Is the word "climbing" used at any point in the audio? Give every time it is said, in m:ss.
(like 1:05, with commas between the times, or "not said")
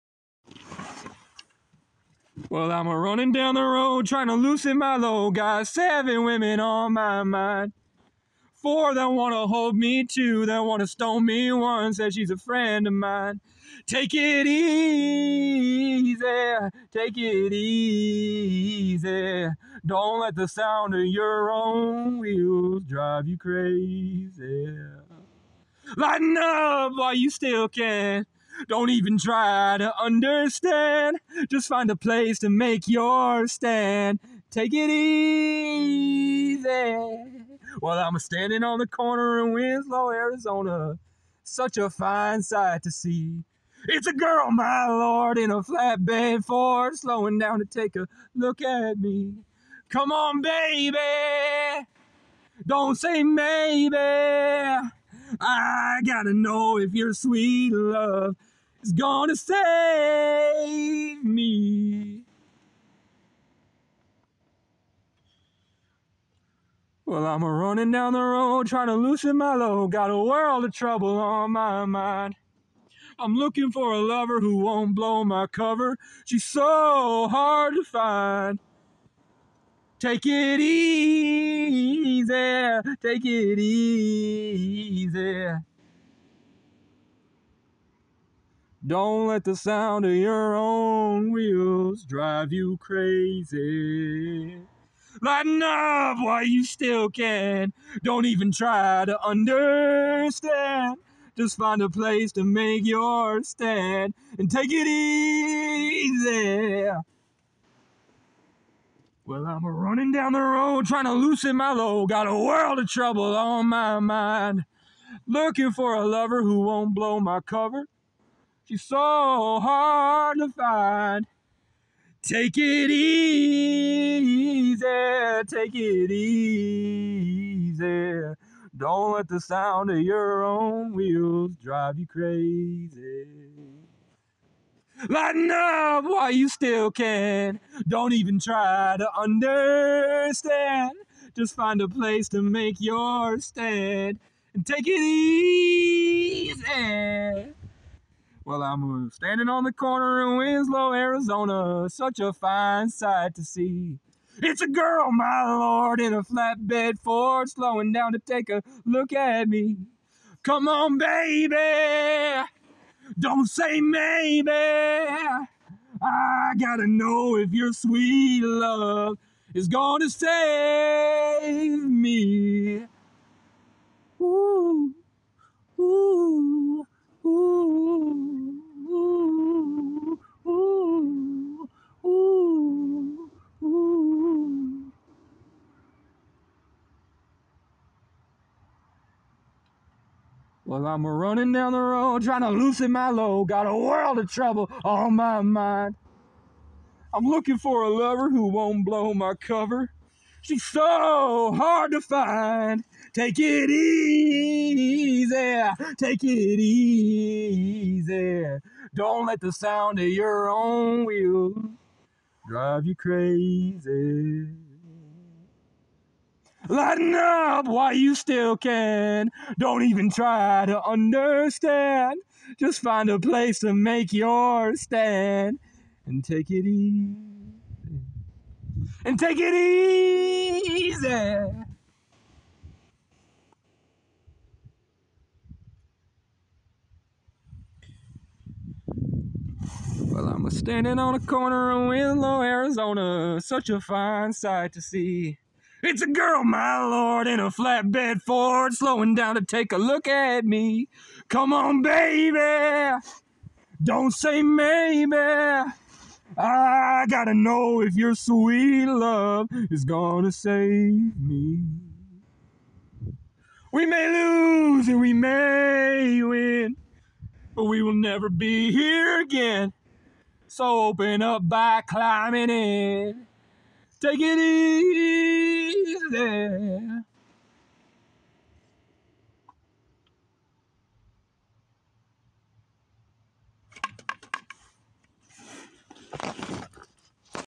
4:31.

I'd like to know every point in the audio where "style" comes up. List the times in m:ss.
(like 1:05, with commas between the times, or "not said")
not said.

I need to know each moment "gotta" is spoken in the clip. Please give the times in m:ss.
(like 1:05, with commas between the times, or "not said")
0:56, 2:46, 4:17.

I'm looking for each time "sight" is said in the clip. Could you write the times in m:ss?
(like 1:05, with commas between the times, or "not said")
0:42, 2:32, 4:04.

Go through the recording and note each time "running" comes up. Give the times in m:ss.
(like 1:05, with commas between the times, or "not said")
0:02, 1:07, 1:49, 3:11.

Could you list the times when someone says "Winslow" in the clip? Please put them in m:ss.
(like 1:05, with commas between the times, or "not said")
0:39, 2:30, 4:01.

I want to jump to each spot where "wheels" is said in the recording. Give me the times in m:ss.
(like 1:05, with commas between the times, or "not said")
0:22, 1:31, 2:10, 3:31.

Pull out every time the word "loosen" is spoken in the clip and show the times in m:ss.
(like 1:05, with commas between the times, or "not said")
0:04, 1:08, 1:51, 3:12.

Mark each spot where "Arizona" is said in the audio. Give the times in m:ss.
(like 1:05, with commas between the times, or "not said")
0:40, 2:30, 4:02.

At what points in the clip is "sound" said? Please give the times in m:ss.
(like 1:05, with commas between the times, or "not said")
0:20, 1:29, 2:09, 3:29.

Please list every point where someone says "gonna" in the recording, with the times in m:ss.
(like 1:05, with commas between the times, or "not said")
0:58, 2:49, 4:19.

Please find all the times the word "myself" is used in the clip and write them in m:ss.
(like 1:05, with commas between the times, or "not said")
not said.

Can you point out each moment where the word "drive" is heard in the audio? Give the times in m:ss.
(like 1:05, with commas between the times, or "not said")
0:22, 1:32, 2:11, 3:32.